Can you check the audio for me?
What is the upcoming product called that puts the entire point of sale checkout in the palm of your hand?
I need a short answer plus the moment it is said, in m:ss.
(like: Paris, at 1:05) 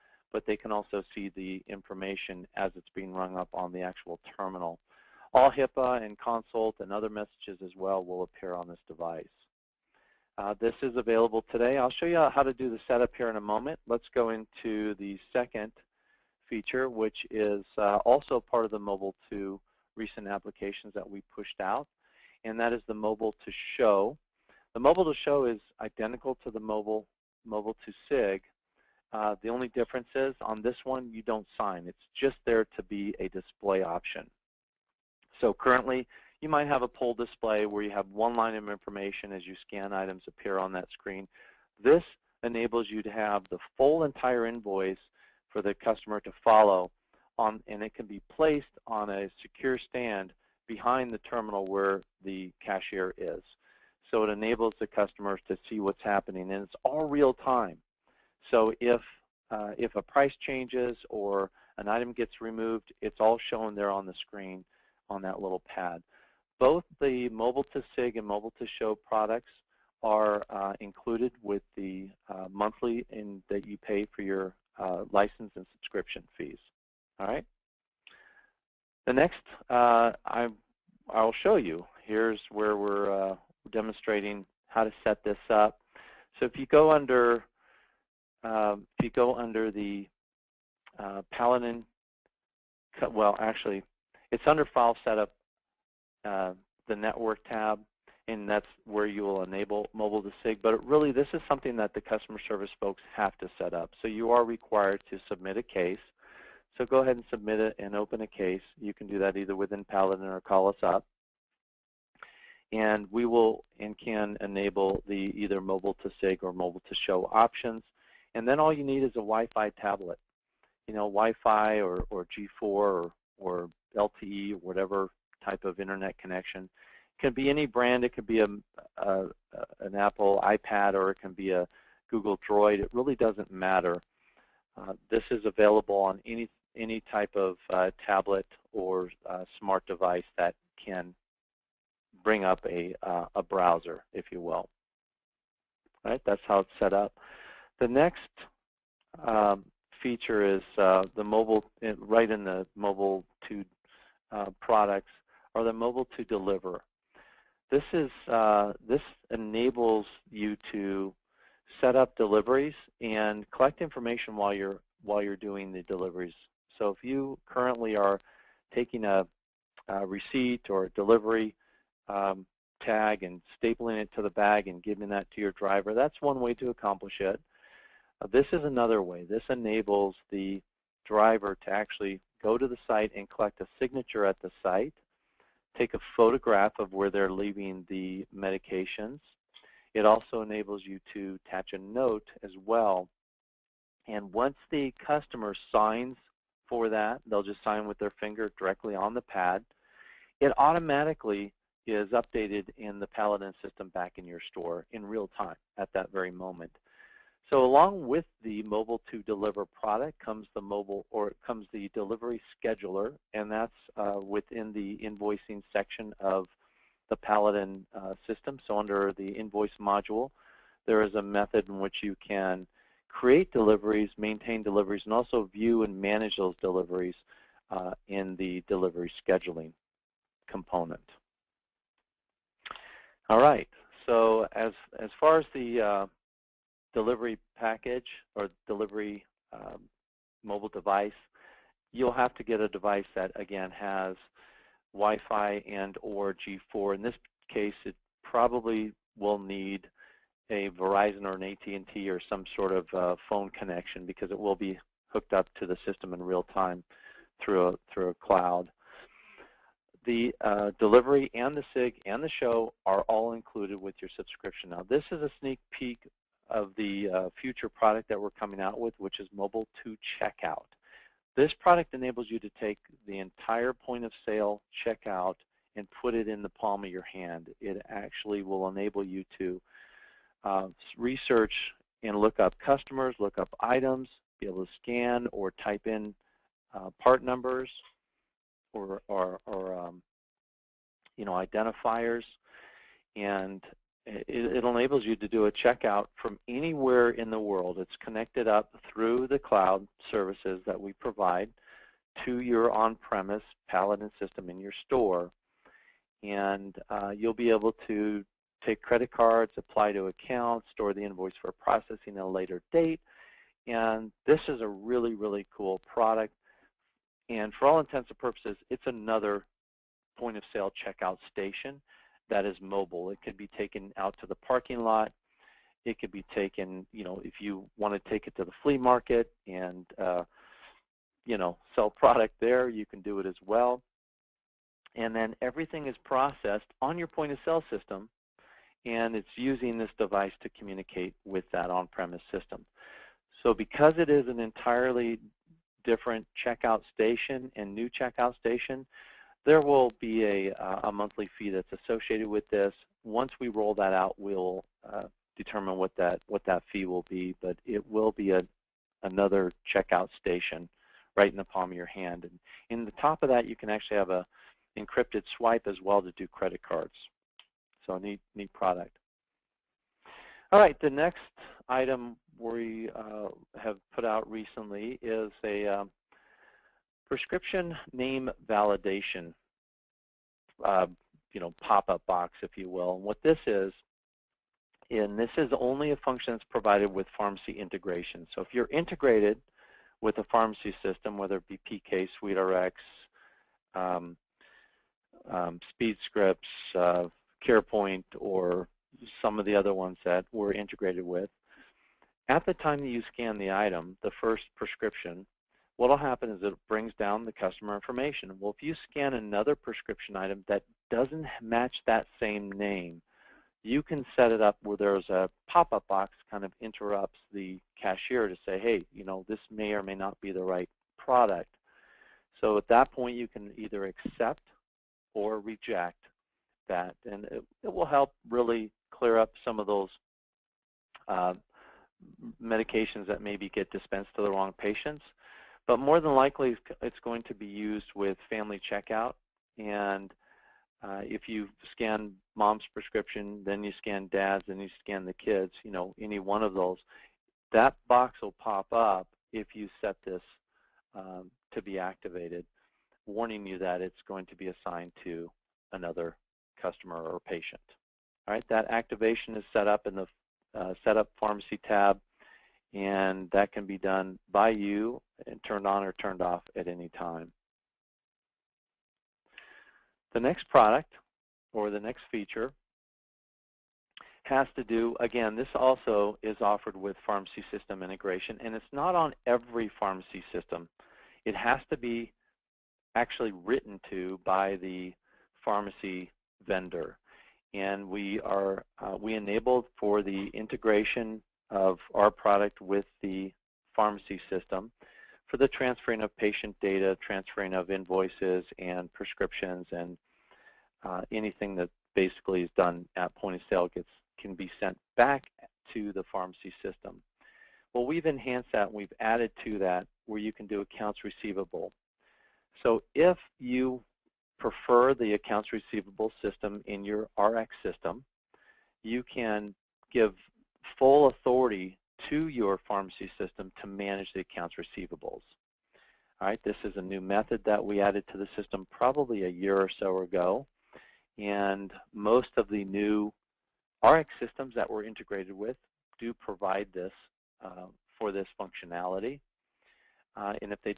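Mobile 2 Checkout, at 4:29.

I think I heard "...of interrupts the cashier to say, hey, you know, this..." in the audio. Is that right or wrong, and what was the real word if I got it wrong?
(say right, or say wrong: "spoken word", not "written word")
right.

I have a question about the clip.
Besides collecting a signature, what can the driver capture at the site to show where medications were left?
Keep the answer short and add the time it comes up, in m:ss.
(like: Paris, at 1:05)
a photograph, at 3:05.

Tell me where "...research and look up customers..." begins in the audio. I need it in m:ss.
4:40.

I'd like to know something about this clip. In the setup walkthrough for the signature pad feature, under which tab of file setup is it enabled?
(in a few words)
network tab.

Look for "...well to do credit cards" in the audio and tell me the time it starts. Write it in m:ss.
6:05.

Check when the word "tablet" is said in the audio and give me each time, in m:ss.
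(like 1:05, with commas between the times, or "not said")
1:59, 2:18.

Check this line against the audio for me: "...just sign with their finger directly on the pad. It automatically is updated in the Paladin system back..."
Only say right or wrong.
right.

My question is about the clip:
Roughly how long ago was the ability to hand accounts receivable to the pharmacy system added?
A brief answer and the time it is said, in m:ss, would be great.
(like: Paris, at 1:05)
a year or so, at 8:49.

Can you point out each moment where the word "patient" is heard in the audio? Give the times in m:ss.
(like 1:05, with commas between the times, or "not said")
7:14, 7:37, 8:16.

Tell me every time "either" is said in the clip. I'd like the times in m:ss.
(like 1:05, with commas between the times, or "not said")
1:49, 1:55, 7:03.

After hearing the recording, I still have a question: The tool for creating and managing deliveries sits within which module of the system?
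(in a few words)
invoice module.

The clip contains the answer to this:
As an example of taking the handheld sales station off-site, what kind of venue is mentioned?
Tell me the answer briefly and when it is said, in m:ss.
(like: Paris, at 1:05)
flea market, at 5:28.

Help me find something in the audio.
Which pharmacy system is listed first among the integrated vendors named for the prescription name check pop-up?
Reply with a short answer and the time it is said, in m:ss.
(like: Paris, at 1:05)
PK, at 6:31.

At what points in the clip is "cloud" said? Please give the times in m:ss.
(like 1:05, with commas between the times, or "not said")
4:18, 4:59.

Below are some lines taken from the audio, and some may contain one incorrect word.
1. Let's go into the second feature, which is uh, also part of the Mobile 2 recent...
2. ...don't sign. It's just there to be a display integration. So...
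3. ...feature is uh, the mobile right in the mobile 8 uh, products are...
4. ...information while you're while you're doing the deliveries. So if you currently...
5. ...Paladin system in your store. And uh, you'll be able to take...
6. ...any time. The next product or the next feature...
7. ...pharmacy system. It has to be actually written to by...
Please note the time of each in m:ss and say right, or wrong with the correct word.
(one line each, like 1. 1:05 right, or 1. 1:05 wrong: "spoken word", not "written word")
1. 0:13 right
2. 0:31 wrong: "option", not "integration"
3. 2:30 wrong: "2", not "8"
4. 2:43 right
5. 5:03 right
6. 7:46 right
7. 7:59 right.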